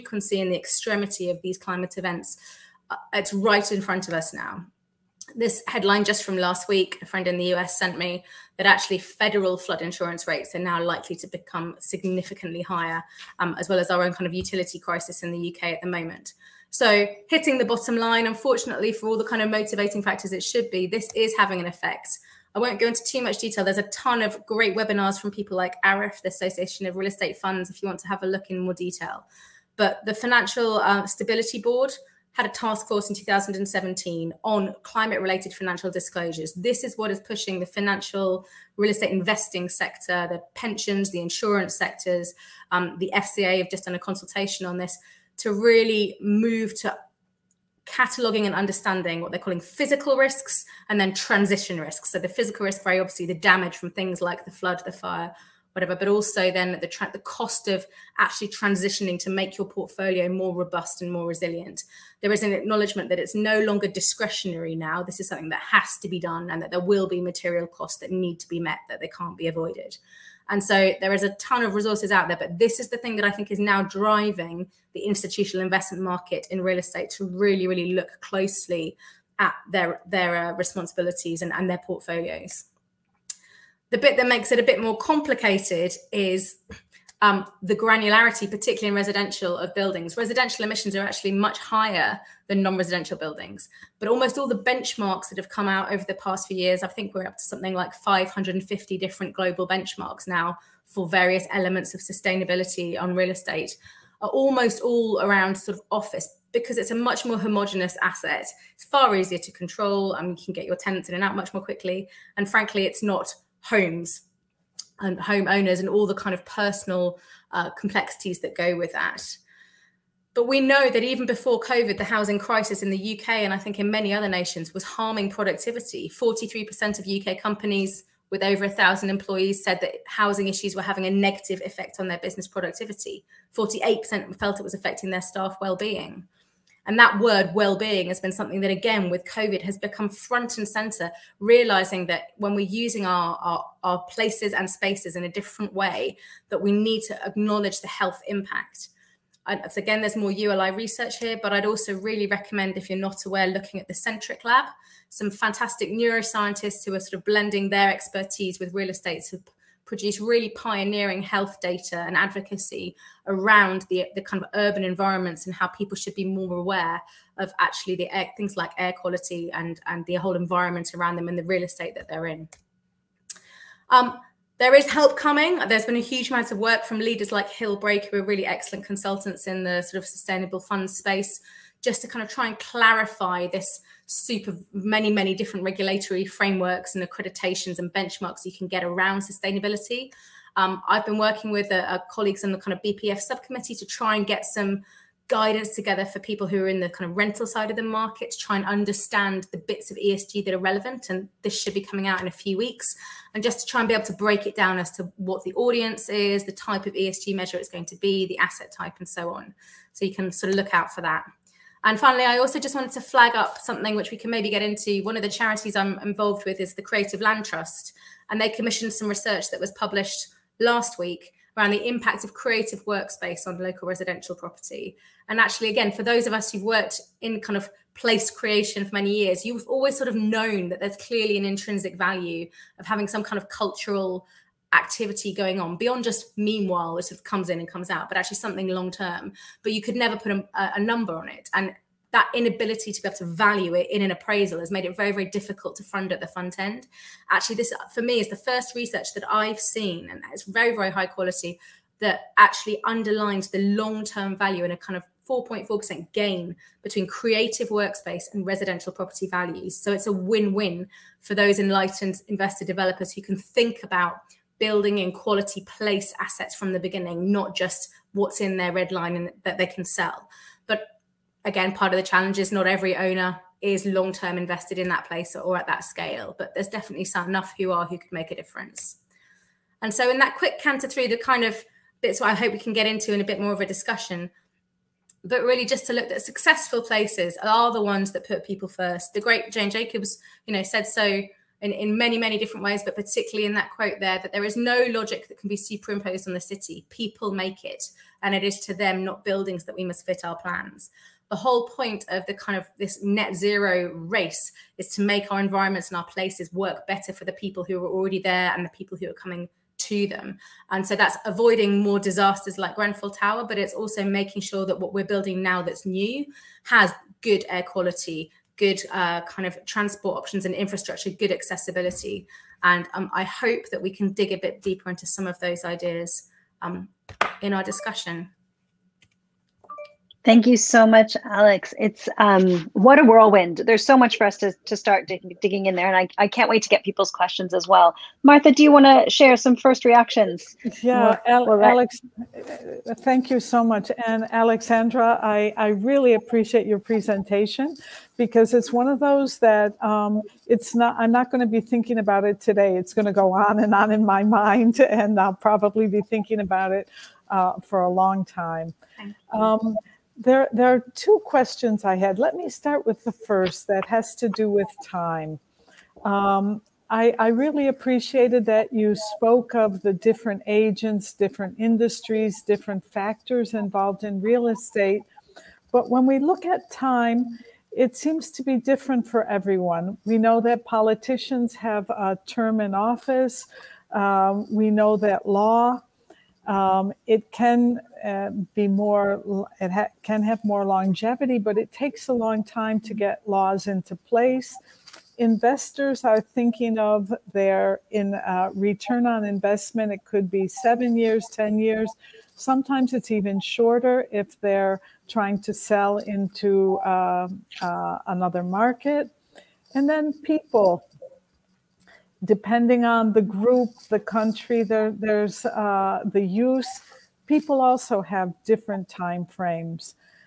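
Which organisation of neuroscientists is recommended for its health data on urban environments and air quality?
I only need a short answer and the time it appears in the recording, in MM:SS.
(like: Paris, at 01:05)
Centric Lab, at 02:33.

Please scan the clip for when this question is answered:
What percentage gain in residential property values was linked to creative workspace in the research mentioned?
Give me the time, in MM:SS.
04:15.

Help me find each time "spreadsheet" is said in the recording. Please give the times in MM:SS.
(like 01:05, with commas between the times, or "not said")
not said.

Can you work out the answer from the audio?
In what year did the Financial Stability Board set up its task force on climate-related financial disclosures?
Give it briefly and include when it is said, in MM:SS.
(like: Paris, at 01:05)
2017, at 00:33.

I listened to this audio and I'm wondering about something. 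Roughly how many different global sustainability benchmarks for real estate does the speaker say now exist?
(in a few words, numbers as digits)
550.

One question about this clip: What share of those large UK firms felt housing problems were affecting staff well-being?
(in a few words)
48%.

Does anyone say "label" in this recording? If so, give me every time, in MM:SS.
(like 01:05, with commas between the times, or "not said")
not said.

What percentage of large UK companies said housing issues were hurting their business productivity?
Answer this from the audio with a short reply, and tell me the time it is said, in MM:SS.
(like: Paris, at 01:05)
43%, at 02:06.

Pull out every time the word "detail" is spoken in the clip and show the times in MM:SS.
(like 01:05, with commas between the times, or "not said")
00:23, 00:28.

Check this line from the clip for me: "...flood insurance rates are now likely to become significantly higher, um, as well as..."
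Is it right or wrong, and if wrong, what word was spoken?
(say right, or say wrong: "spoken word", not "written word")
right.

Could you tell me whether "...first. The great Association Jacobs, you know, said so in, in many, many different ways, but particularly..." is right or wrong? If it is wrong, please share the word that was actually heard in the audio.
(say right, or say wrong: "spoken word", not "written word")
wrong: "Jane", not "Association".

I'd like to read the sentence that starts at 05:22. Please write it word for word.
And um, I hope that we can dig a bit deeper into some of those ideas um, in our discussion.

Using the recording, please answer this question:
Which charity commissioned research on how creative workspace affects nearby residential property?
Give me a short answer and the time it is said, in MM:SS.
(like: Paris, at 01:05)
Creative Land Trust, at 03:36.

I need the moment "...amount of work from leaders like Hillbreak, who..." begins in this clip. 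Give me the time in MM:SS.
02:56.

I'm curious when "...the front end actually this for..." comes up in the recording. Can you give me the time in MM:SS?
04:06.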